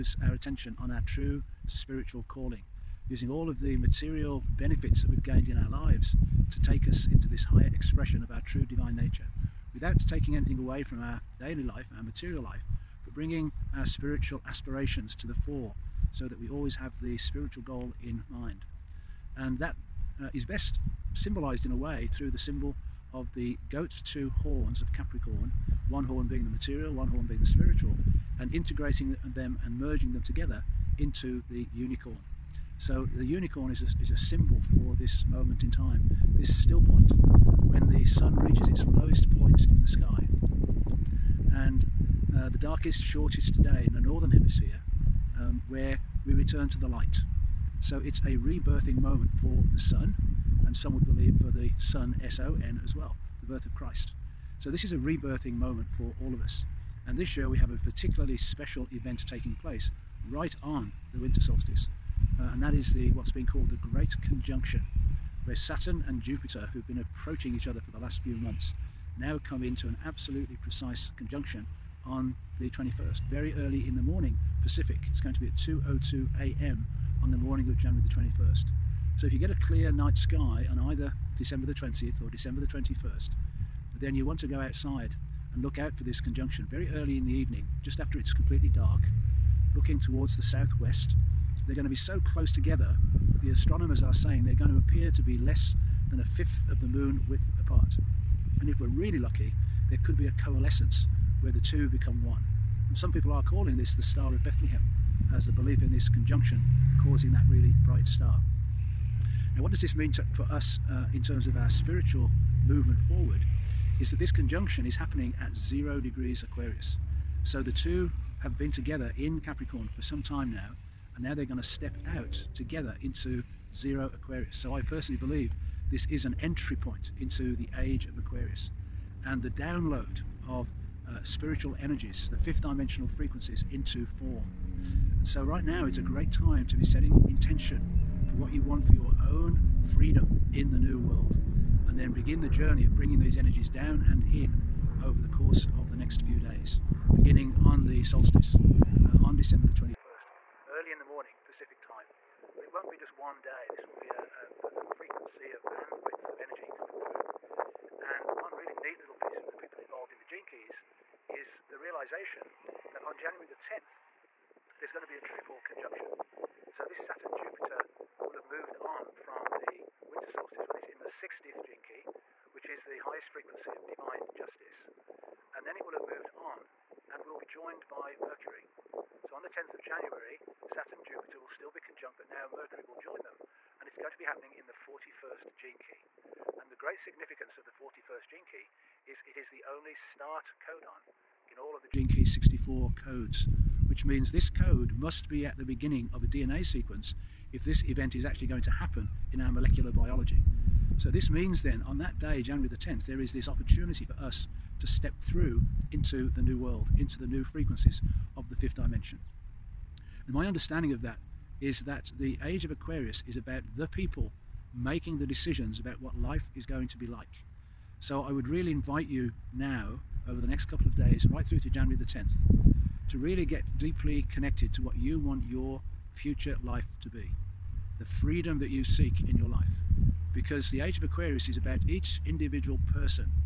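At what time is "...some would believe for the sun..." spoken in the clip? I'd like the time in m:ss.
0:50.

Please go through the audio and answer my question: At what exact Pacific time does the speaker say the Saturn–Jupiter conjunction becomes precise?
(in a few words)
2:02 a.m.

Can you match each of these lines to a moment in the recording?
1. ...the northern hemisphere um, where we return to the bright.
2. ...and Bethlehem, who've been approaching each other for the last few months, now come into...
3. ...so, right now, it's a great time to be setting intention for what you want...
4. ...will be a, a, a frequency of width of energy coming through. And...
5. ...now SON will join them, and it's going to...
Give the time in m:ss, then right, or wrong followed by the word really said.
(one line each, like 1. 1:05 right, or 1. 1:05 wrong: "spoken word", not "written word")
1. 0:43 wrong: "light", not "bright"
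2. 1:06 wrong: "Jupiter", not "Bethlehem"
3. 2:15 right
4. 2:33 wrong: "bandwidth", not "width"
5. 3:02 wrong: "Mercury", not "SON".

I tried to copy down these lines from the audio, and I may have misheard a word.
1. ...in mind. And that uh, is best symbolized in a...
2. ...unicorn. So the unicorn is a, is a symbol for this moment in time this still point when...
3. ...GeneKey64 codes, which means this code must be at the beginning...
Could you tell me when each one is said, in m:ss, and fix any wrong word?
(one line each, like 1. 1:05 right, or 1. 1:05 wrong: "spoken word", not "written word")
1. 0:18 right
2. 0:31 right
3. 3:11 right.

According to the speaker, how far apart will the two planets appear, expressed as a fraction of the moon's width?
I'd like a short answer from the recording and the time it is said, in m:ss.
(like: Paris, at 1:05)
less than a fifth, at 1:35.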